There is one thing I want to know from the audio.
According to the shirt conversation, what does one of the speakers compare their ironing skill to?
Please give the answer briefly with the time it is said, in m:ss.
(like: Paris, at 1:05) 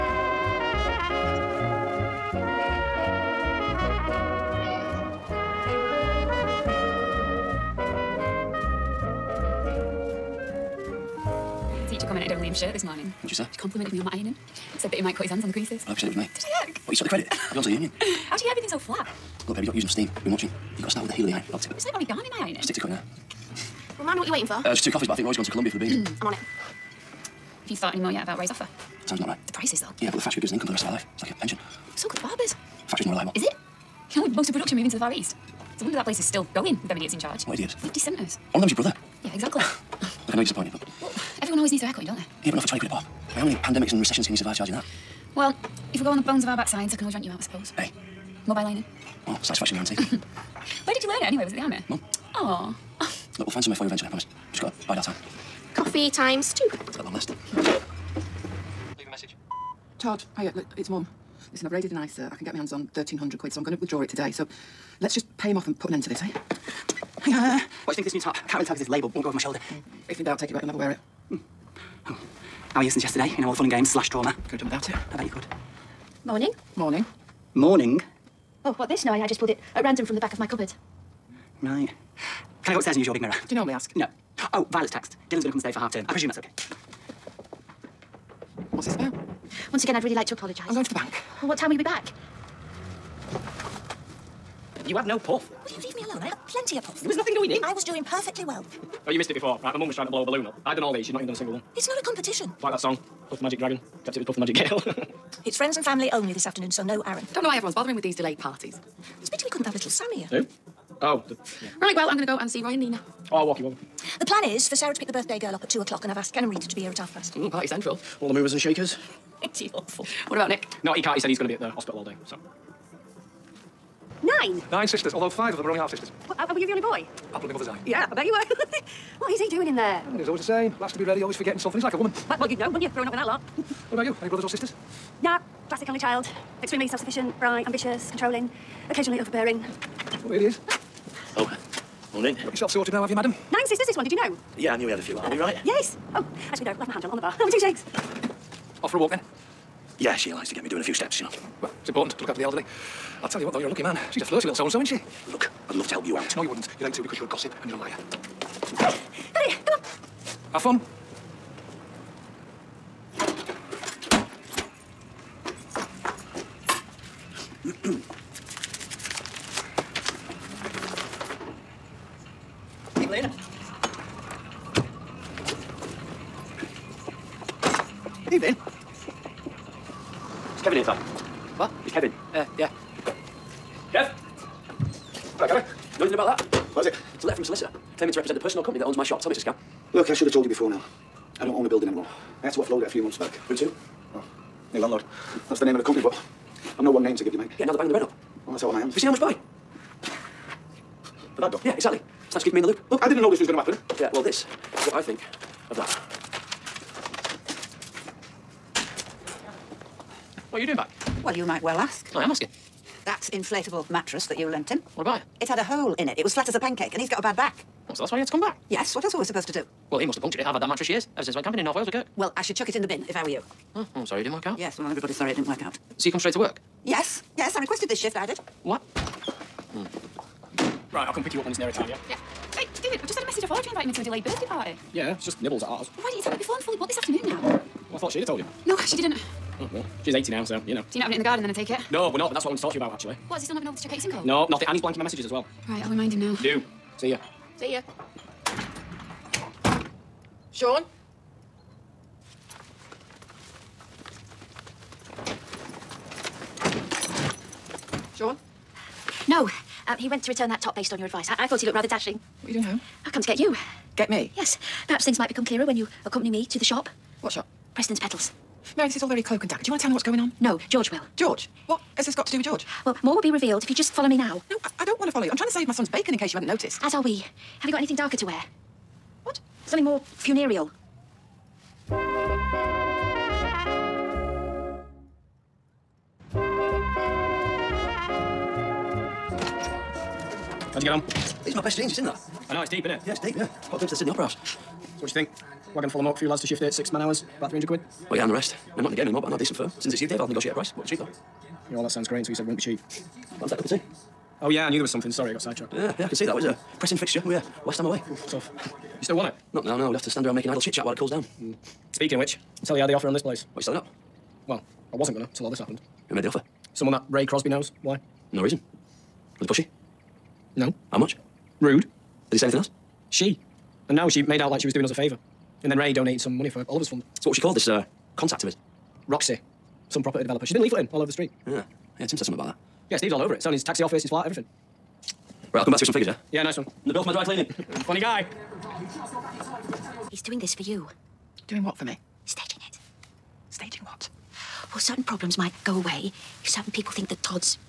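origami, at 0:21.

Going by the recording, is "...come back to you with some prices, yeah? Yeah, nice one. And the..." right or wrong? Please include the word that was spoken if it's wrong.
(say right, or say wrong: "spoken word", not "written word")
wrong: "figures", not "prices".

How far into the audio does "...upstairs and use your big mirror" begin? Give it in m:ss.
1:22.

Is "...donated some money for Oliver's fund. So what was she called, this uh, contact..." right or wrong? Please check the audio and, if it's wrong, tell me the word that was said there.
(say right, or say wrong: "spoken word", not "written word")
right.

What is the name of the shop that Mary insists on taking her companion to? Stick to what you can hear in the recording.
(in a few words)
Preston's Petals.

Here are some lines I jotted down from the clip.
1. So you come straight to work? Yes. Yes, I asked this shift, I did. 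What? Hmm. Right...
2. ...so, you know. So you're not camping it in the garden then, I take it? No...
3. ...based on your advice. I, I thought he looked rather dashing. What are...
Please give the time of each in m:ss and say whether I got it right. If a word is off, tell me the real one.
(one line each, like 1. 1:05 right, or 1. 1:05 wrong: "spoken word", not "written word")
1. 3:45 wrong: "requested", not "asked"
2. 4:00 wrong: "having", not "camping"
3. 4:20 right.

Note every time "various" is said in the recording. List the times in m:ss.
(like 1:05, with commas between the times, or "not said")
not said.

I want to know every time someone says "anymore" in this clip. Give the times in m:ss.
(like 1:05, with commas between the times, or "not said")
3:11, 4:59.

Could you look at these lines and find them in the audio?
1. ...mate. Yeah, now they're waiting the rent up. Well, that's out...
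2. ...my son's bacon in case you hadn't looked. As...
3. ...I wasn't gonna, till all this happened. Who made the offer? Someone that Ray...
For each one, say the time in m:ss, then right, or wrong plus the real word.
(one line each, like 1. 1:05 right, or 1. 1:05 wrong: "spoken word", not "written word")
1. 3:17 wrong: "banging", not "waiting"
2. 4:35 wrong: "noticed", not "looked"
3. 5:14 right.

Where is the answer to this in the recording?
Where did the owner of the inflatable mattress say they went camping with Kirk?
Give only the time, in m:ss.
3:41.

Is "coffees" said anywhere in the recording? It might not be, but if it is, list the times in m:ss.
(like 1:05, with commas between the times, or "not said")
0:24, 0:55.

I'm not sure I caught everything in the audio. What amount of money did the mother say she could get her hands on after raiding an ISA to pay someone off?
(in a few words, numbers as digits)
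£1,300.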